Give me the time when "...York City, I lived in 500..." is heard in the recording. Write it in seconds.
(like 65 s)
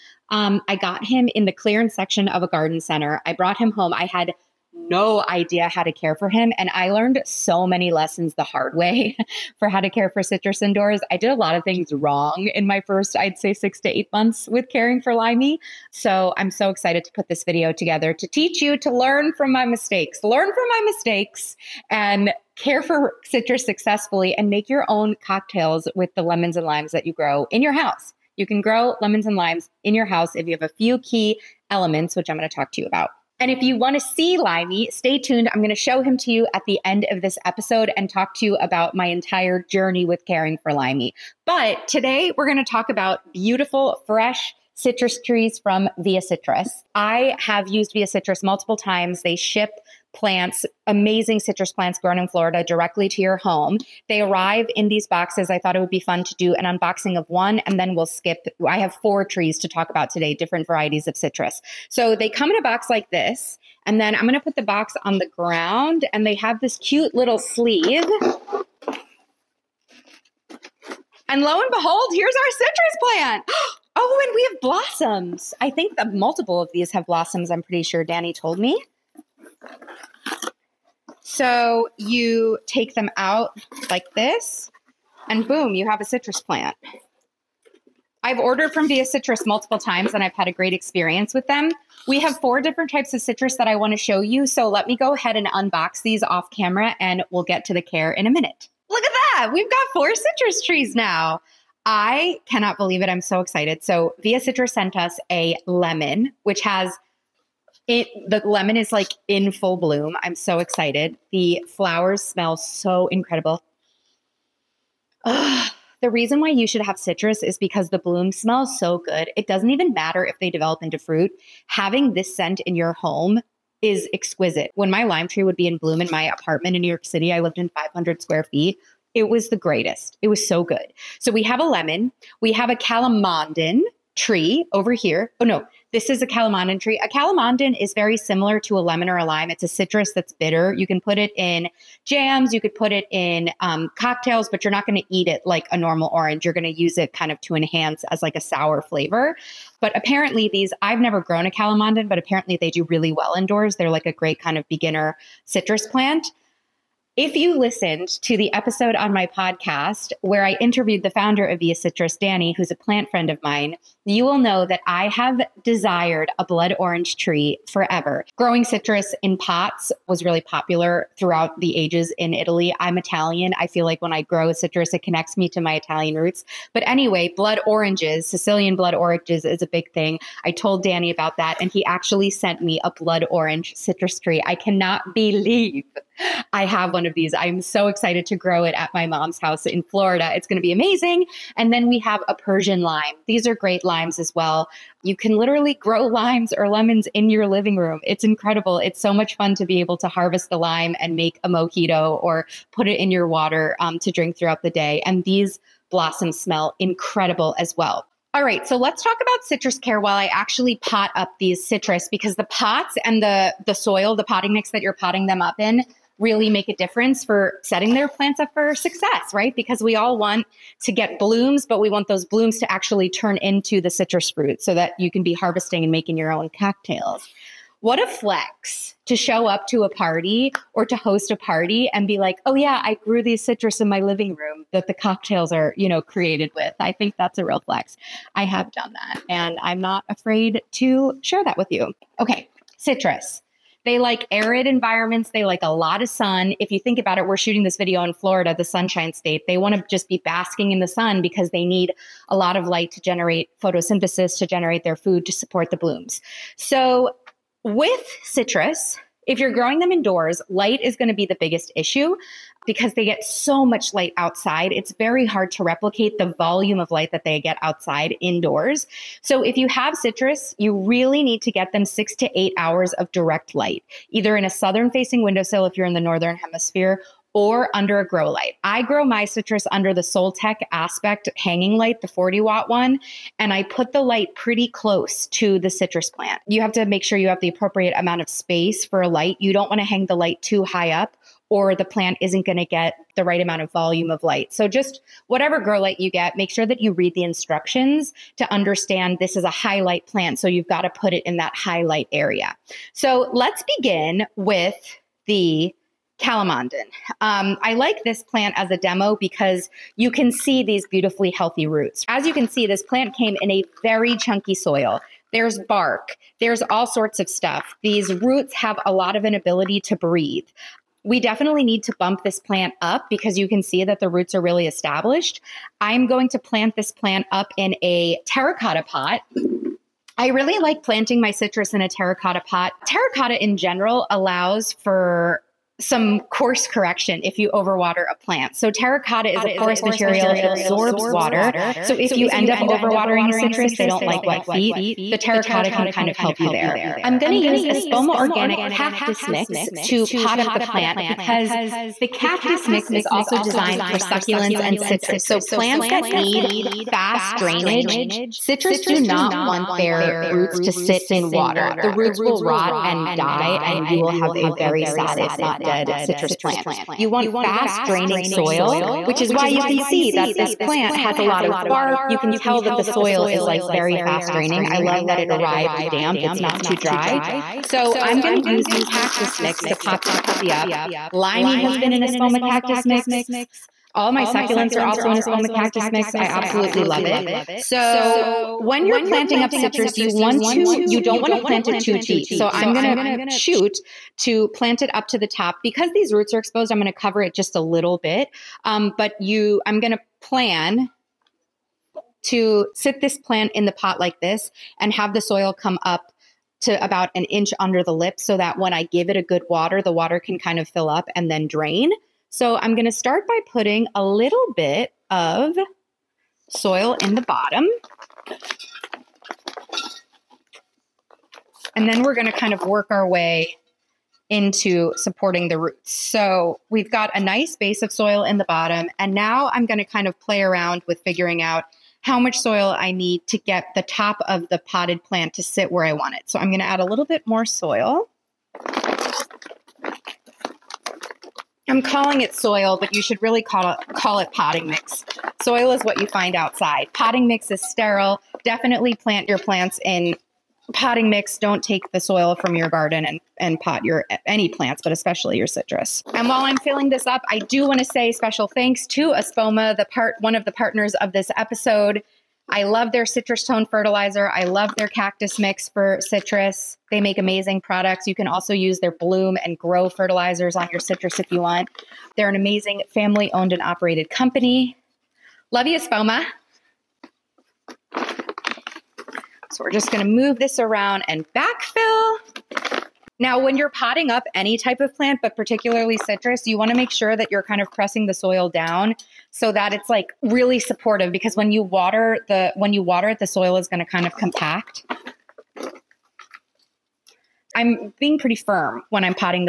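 126 s.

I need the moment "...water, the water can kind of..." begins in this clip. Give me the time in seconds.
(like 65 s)
409 s.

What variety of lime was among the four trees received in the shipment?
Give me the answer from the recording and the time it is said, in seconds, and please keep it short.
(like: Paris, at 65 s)
Persian lime, at 192 s.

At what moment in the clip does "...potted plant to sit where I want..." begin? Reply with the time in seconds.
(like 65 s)
434 s.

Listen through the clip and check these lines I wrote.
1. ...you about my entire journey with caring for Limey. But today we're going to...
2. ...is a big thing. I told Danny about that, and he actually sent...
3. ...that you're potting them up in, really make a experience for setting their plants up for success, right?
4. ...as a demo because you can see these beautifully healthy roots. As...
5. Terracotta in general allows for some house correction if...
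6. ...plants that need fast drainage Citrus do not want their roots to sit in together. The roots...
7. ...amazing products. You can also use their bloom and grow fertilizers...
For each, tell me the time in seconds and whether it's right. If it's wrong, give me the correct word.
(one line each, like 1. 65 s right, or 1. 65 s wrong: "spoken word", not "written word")
1. 38 s right
2. 179 s right
3. 214 s wrong: "difference", not "experience"
4. 308 s right
5. 332 s wrong: "course", not "house"
6. 355 s wrong: "water", not "together"
7. 467 s right.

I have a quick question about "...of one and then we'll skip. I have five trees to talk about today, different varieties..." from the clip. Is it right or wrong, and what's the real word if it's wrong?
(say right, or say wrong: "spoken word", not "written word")
wrong: "four", not "five".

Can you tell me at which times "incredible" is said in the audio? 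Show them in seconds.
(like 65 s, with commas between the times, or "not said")
113 s, 198 s, 206 s.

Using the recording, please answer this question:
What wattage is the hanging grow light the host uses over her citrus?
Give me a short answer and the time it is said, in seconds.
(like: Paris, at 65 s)
40 watt, at 282 s.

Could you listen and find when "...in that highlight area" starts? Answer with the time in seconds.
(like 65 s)
301 s.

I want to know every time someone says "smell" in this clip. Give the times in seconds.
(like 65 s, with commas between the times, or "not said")
112 s, 118 s, 206 s.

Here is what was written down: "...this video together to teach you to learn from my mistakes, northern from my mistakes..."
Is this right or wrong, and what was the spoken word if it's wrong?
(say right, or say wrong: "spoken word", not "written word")
wrong: "learn", not "northern".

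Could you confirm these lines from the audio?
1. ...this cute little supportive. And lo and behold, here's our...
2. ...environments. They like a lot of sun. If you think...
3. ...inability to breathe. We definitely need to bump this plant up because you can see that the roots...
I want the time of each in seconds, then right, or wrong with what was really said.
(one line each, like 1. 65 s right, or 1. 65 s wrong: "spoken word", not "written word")
1. 66 s wrong: "sleeve", not "supportive"
2. 244 s right
3. 319 s right.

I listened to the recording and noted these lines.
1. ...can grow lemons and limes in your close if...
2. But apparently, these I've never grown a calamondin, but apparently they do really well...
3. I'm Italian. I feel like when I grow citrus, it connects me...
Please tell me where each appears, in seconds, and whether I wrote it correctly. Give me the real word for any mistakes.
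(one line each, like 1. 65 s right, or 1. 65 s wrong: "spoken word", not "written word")
1. 28 s wrong: "house", not "close"
2. 149 s right
3. 172 s right.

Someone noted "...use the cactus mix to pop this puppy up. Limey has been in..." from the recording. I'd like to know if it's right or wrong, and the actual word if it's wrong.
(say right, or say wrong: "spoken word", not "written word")
right.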